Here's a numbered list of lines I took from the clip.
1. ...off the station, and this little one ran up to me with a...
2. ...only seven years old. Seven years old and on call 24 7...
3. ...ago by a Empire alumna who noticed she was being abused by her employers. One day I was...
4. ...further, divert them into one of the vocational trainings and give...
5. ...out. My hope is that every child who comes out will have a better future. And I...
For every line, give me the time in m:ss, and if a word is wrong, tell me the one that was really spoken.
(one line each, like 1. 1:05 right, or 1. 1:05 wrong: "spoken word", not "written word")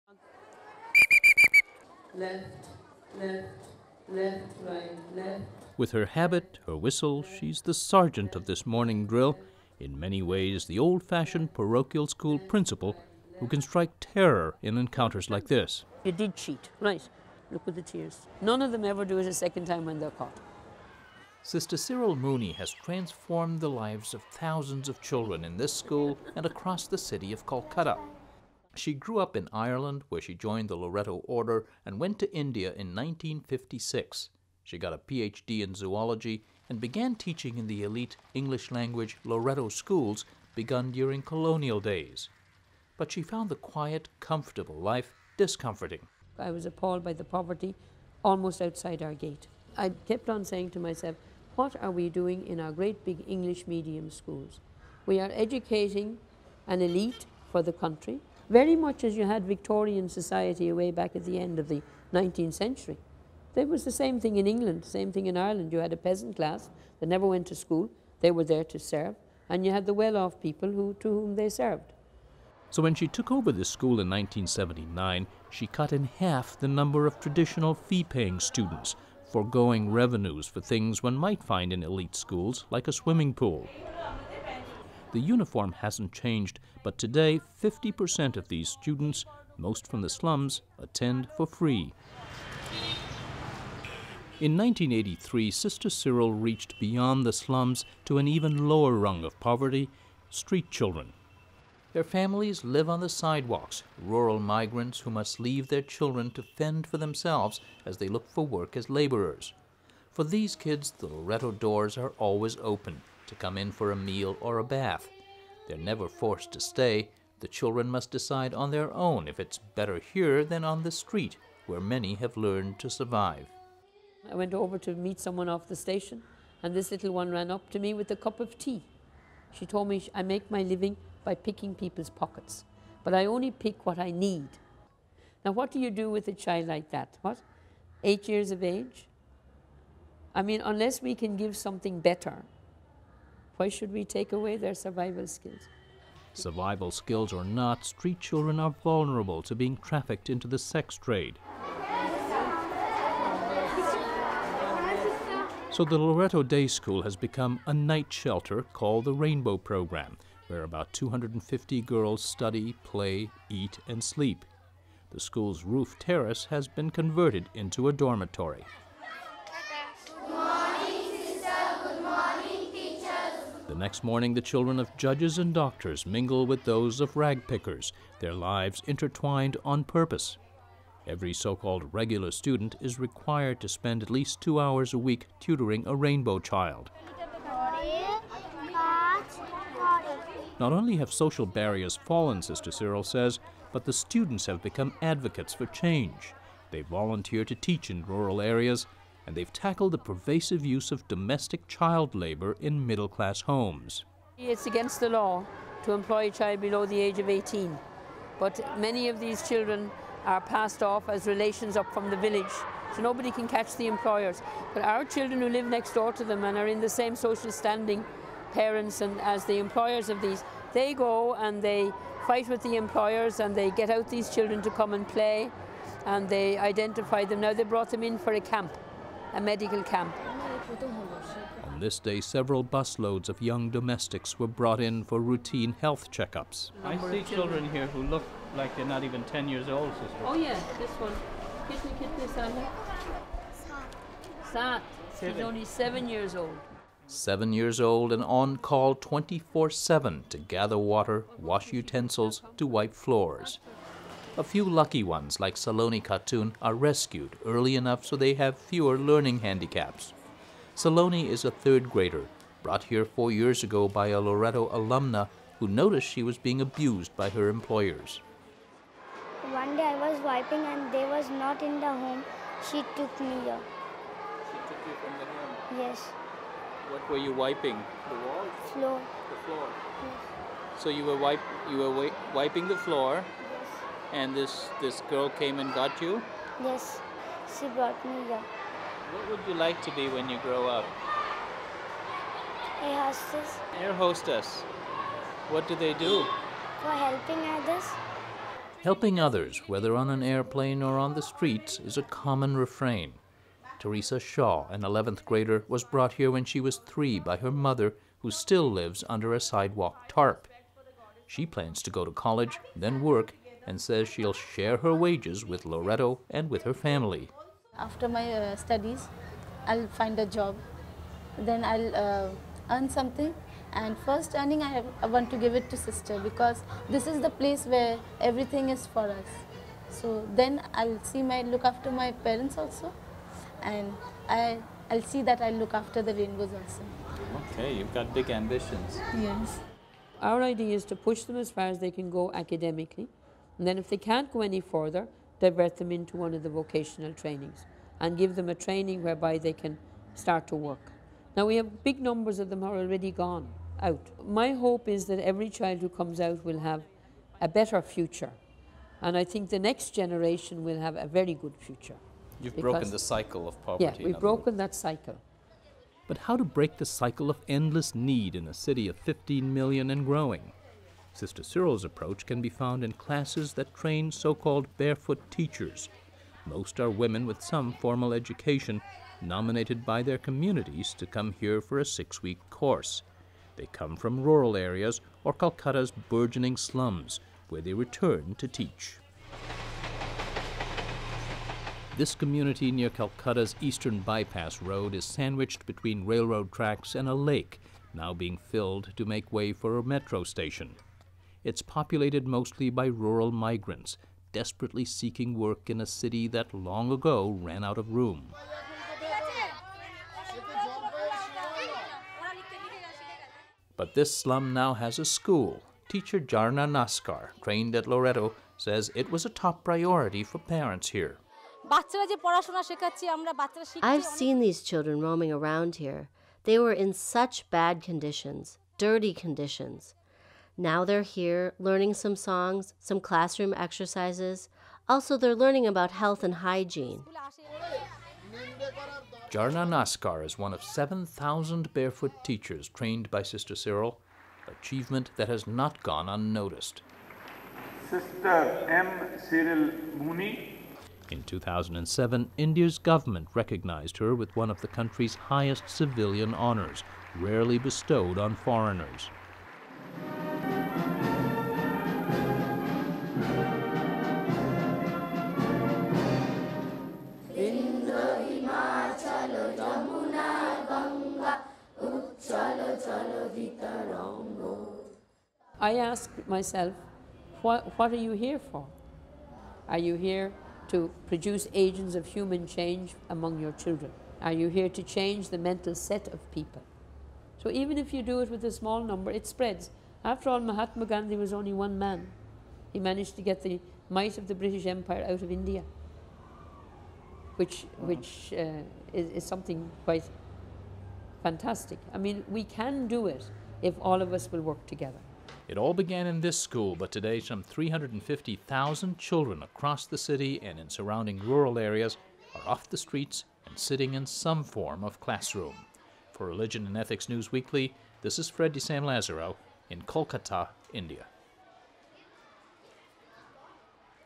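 1. 2:05 right
2. 4:05 right
3. 4:23 wrong: "Loreto", not "Empire"
4. 5:44 right
5. 5:53 right.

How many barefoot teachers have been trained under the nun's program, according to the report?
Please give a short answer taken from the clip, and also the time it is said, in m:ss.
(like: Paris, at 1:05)
7,000, at 7:20.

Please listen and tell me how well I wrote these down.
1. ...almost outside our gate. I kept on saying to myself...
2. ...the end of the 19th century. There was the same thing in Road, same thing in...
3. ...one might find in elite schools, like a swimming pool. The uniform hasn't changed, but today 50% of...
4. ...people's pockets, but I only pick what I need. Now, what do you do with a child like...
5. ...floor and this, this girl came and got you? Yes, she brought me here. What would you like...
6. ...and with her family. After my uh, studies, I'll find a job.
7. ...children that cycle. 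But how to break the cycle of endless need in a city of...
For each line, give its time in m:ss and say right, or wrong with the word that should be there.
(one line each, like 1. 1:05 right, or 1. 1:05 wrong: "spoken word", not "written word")
1. 0:48 right
2. 1:01 wrong: "England", not "Road"
3. 1:21 right
4. 2:11 right
5. 4:42 right
6. 5:16 right
7. 6:04 wrong: "broken", not "children".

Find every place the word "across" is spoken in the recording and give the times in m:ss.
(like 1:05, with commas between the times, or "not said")
0:26, 8:29.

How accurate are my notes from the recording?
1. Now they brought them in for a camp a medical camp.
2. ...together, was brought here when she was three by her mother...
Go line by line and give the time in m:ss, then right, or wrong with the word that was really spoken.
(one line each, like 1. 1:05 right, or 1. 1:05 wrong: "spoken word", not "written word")
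1. 3:47 right
2. 5:05 wrong: "grader", not "together".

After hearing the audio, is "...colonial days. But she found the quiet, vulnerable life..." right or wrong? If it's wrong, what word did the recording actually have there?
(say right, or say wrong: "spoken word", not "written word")
wrong: "comfortable", not "vulnerable".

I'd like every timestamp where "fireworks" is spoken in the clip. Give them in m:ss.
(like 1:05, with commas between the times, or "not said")
not said.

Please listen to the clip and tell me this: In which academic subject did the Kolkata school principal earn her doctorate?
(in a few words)
zoology.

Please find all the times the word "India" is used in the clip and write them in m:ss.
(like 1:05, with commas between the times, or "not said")
0:32, 7:32, 8:15, 8:40.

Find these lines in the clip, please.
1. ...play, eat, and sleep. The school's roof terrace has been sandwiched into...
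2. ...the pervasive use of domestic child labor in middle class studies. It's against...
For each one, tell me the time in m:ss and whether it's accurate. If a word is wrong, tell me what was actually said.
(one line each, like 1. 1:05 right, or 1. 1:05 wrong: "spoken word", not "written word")
1. 2:42 wrong: "converted", not "sandwiched"
2. 3:19 wrong: "homes", not "studies".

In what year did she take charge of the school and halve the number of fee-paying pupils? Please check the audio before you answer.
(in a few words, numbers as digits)
1979.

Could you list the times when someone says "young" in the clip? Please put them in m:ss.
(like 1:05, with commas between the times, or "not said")
3:53.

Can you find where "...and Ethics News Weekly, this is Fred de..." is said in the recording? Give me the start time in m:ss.
8:36.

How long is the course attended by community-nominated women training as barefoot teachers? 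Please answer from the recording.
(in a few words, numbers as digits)
6 weeks.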